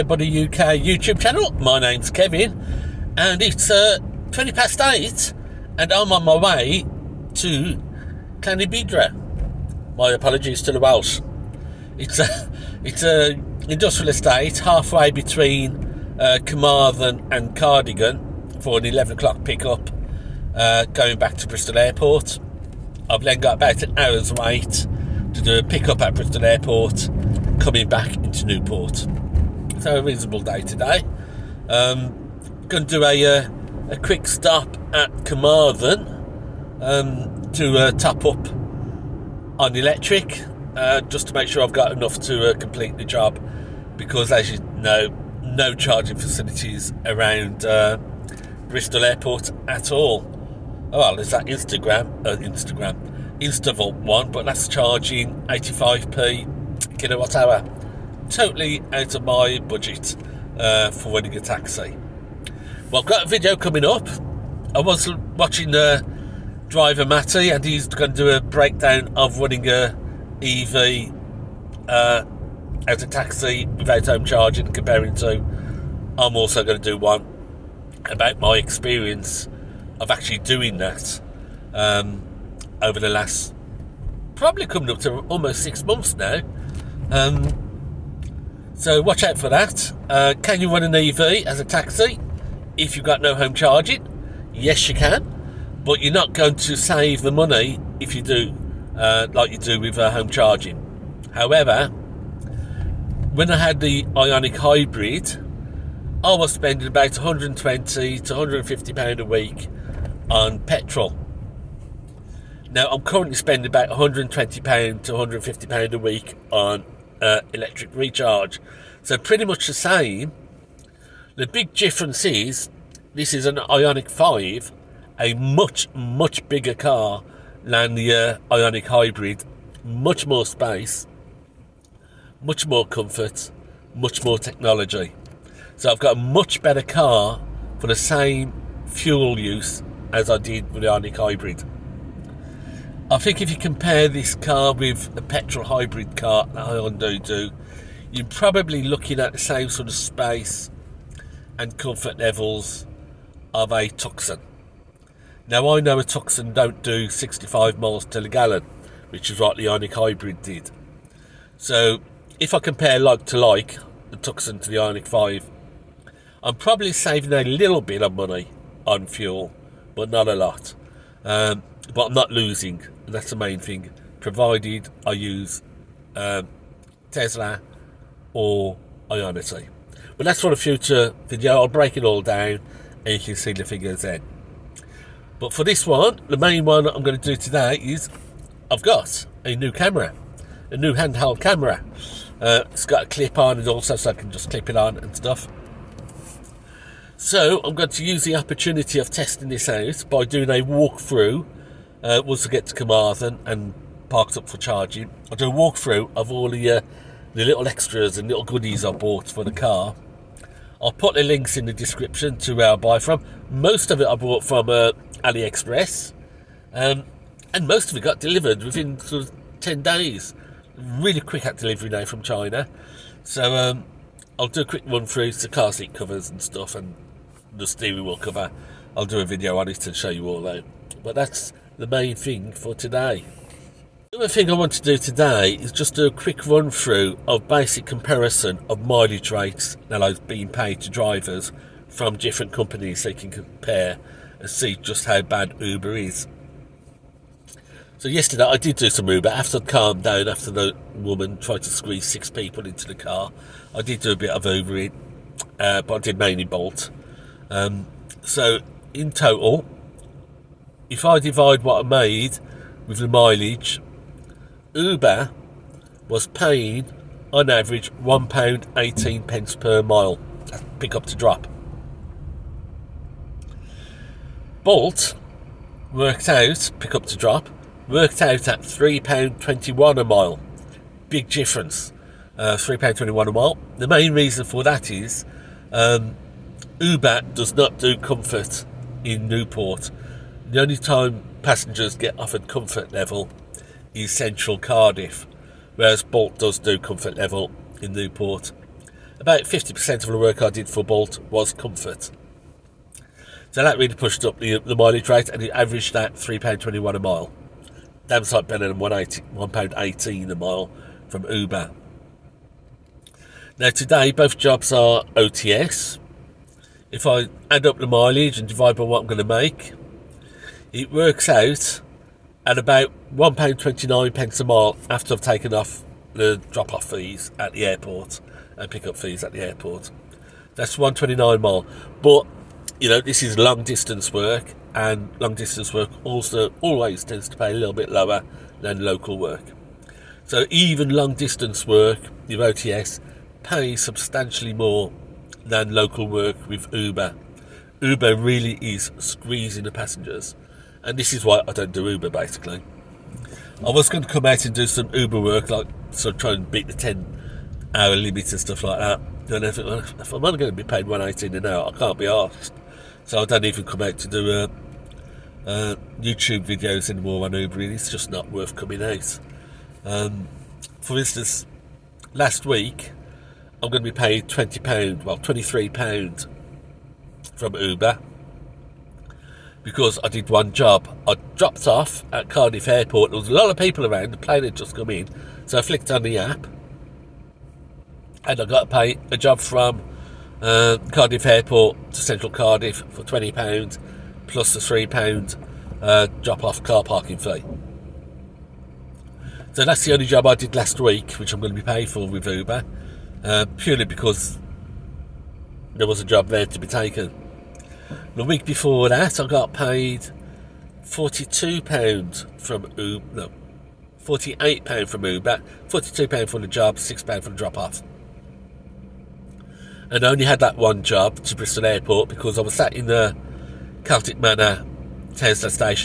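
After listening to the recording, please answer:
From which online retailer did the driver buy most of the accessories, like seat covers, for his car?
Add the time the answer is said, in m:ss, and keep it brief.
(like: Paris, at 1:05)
AliExpress, at 3:35.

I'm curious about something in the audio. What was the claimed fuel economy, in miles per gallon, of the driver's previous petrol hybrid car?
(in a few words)
65.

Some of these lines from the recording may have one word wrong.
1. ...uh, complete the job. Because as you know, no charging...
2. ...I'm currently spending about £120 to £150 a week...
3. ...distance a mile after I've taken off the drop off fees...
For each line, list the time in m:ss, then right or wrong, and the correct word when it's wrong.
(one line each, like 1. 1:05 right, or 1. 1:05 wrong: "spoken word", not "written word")
1. 0:42 right
2. 1:52 right
3. 5:24 wrong: "pence", not "distance".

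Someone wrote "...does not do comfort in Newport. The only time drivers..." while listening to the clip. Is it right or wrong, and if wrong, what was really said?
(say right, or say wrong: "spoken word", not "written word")
wrong: "passengers", not "drivers".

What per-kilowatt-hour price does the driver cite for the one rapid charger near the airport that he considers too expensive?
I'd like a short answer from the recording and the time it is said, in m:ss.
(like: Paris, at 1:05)
85p, at 0:55.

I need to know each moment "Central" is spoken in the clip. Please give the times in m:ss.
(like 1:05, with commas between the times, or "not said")
4:54, 6:32.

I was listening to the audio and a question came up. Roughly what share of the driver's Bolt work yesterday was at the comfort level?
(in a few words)
50%.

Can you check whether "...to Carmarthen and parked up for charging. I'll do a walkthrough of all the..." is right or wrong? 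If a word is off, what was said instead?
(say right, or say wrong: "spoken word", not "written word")
right.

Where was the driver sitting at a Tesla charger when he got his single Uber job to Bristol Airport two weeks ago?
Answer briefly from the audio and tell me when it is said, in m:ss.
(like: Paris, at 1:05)
Celtic Manor, at 7:03.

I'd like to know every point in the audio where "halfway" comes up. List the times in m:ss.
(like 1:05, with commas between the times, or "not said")
0:14.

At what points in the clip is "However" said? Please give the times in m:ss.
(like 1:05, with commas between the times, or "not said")
1:41.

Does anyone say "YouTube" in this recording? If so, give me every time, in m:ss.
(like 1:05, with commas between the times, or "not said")
0:00, 6:06.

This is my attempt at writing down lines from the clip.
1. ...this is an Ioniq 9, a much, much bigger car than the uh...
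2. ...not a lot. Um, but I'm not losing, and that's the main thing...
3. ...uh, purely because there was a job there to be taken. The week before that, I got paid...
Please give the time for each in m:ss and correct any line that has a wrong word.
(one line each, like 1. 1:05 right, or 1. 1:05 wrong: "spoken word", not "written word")
1. 2:03 wrong: "5", not "9"
2. 2:50 right
3. 6:43 right.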